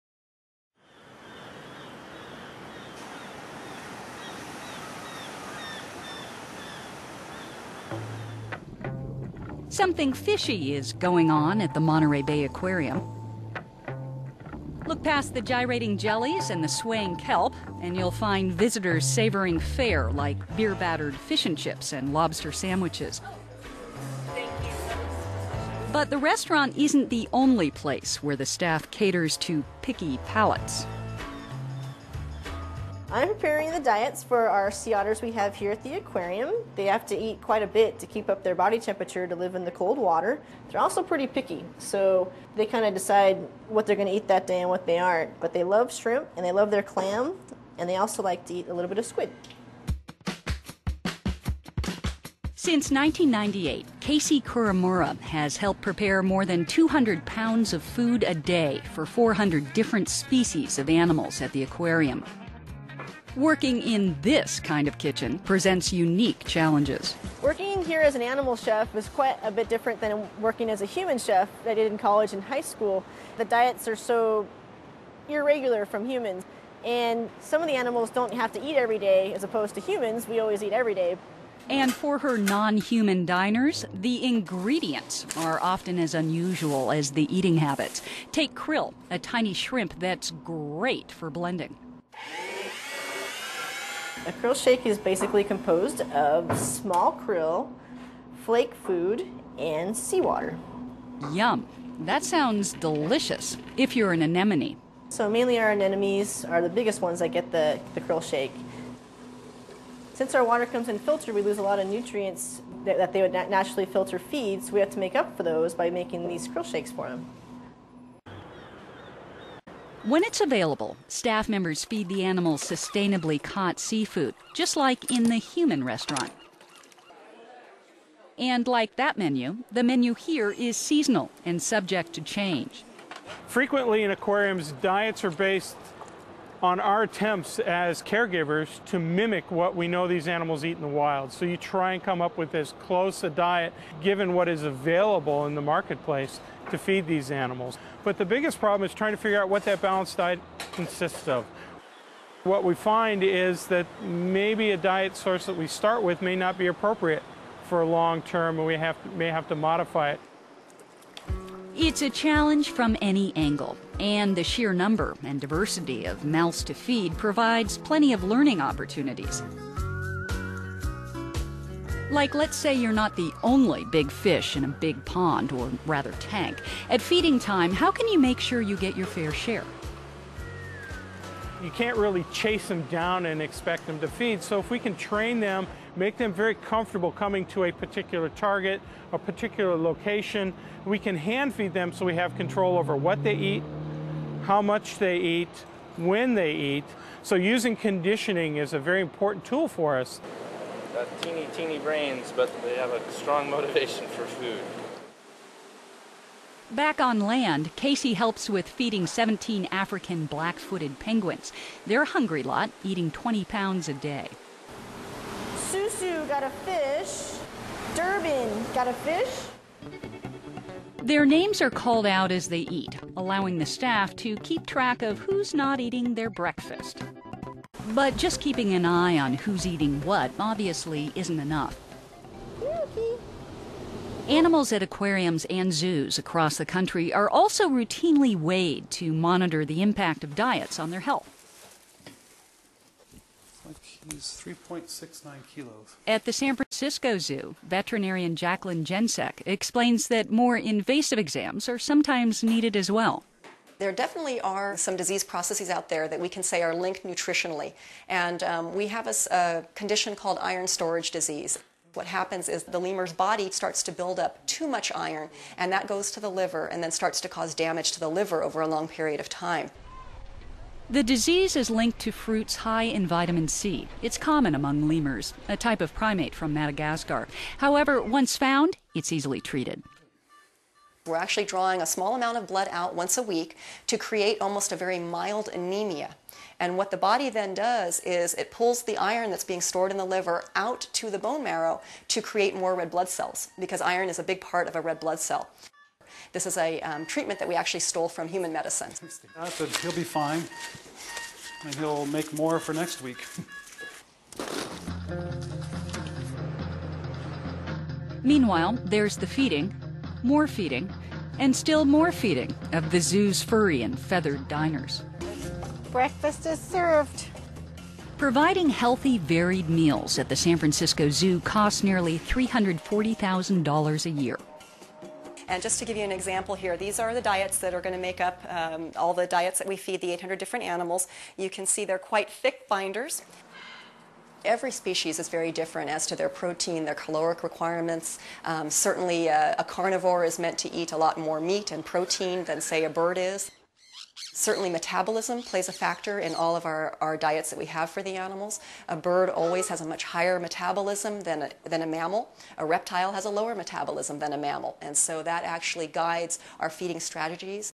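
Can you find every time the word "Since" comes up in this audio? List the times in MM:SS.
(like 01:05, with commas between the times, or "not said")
00:52, 01:50.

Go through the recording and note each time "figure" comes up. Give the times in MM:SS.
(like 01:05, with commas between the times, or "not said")
02:29.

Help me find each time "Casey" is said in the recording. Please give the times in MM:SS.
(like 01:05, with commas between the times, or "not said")
00:53, 03:27.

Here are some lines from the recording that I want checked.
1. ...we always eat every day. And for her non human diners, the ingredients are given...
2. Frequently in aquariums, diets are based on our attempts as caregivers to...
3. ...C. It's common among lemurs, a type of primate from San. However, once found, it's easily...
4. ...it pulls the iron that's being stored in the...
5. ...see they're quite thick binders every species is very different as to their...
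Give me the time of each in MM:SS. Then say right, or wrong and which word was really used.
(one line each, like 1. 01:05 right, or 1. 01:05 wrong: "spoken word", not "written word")
1. 01:20 wrong: "often", not "given"
2. 02:13 right
3. 04:33 wrong: "Madagascar", not "San"
4. 04:48 right
5. 05:31 right.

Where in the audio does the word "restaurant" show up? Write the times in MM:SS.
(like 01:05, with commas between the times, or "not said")
00:26, 02:05.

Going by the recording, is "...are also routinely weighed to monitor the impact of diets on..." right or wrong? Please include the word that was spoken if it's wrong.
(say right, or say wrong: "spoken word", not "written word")
right.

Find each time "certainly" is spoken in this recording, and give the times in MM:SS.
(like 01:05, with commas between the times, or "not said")
05:38, 05:44.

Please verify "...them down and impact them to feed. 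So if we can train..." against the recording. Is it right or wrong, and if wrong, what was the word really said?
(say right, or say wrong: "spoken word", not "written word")
wrong: "expect", not "impact".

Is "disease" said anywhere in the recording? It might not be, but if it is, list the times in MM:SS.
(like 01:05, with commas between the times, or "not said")
04:14, 04:21, 04:31.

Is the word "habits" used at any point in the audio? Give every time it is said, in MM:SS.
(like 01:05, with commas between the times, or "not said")
01:27.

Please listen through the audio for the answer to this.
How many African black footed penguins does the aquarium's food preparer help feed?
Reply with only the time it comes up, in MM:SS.
03:29.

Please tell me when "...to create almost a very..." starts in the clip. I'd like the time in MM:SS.
04:43.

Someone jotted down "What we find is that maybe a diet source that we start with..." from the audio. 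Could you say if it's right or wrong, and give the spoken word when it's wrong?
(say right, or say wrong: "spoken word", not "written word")
right.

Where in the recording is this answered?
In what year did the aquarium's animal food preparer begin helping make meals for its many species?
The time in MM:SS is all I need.
00:52.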